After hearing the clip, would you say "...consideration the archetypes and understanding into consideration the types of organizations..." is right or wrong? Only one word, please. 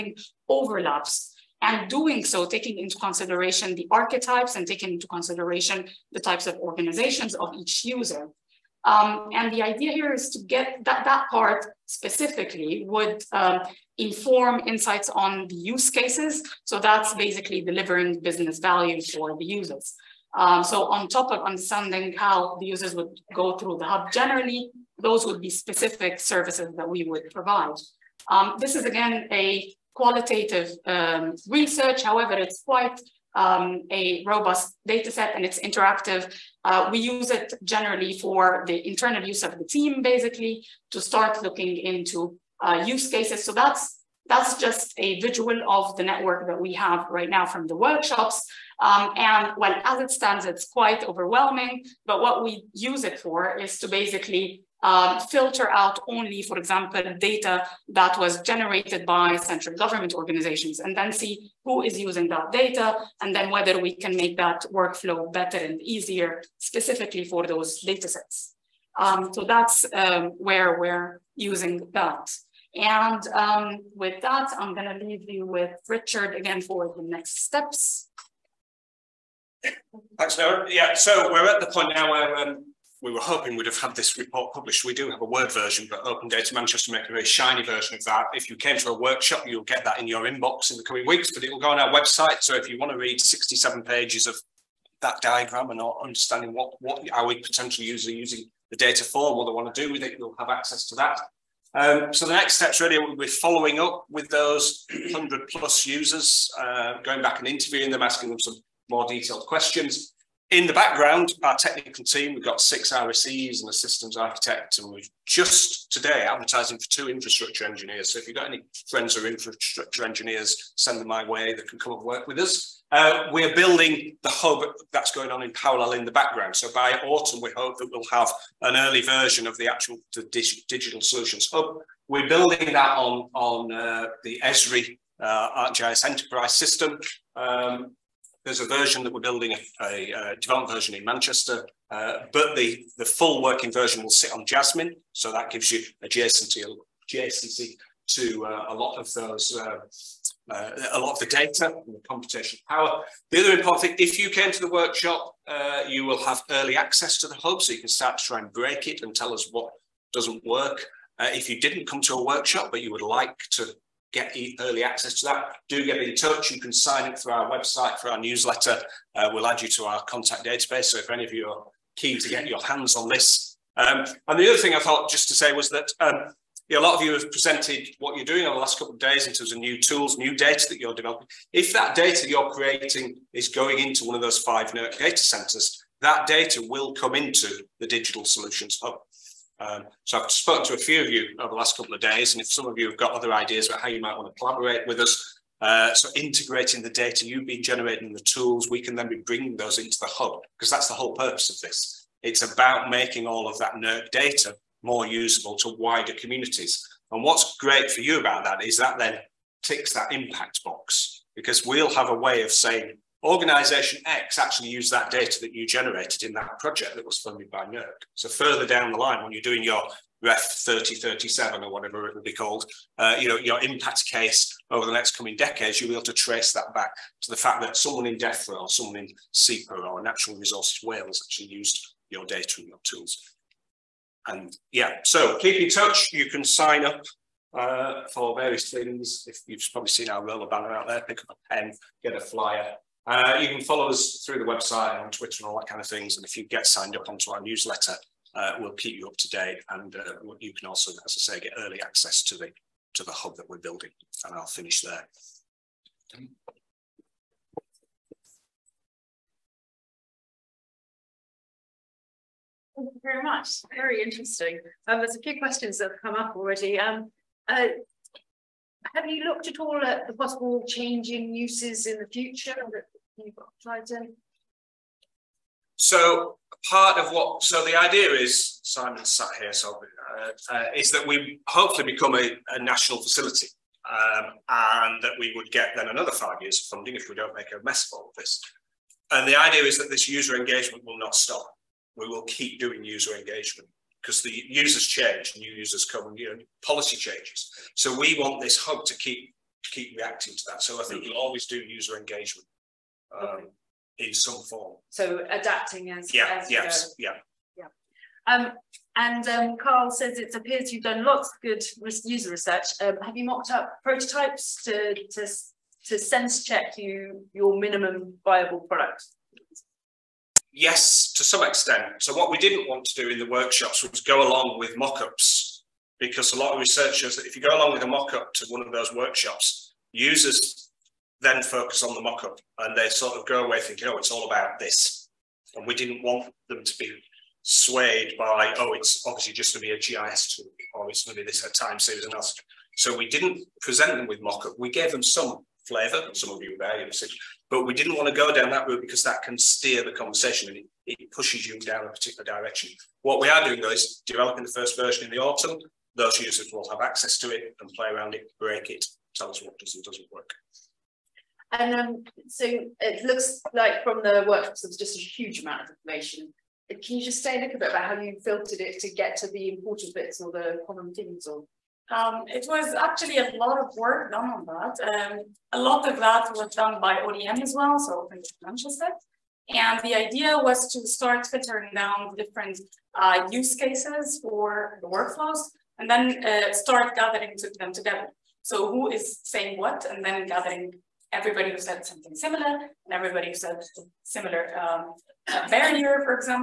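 wrong.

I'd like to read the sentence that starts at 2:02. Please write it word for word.
Uh, we're building the hub that's going on in parallel in the background.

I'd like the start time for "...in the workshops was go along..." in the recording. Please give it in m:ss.
5:23.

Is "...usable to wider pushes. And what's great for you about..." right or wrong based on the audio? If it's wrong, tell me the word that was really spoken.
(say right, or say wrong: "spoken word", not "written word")
wrong: "communities", not "pushes".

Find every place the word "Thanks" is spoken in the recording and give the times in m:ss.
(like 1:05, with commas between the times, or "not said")
1:20, 4:22.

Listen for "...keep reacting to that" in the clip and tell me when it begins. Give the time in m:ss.
4:59.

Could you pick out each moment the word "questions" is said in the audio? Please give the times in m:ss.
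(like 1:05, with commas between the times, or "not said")
1:49, 4:25.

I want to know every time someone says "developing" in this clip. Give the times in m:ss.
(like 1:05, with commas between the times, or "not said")
3:00, 5:54.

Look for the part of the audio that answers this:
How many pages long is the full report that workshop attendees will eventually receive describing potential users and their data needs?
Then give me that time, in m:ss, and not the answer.
1:33.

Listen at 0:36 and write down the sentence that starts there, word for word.
Uh, we use it generally for the internal use of the team, basically, to start looking into uh, use cases.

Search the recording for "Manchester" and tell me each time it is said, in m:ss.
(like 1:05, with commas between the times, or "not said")
1:26, 2:21, 6:18.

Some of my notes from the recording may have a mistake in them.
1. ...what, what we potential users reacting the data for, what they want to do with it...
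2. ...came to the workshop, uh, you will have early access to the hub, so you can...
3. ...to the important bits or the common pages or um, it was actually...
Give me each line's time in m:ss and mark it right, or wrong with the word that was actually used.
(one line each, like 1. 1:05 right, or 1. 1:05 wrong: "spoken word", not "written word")
1. 1:36 wrong: "using", not "reacting"
2. 2:34 right
3. 6:09 wrong: "themes", not "pages".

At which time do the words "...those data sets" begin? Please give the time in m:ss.
1:07.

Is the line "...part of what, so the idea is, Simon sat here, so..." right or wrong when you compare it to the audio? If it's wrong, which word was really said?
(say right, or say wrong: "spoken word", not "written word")
right.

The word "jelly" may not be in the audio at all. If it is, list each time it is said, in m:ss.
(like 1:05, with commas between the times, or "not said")
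not said.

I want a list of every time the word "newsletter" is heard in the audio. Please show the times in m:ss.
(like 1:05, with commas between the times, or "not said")
2:48, 4:07.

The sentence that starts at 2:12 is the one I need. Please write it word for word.
We're building that on on uh, the Esri uh, ArcGIS Enterprise system.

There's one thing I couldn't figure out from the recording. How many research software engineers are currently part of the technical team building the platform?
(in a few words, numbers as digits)
6.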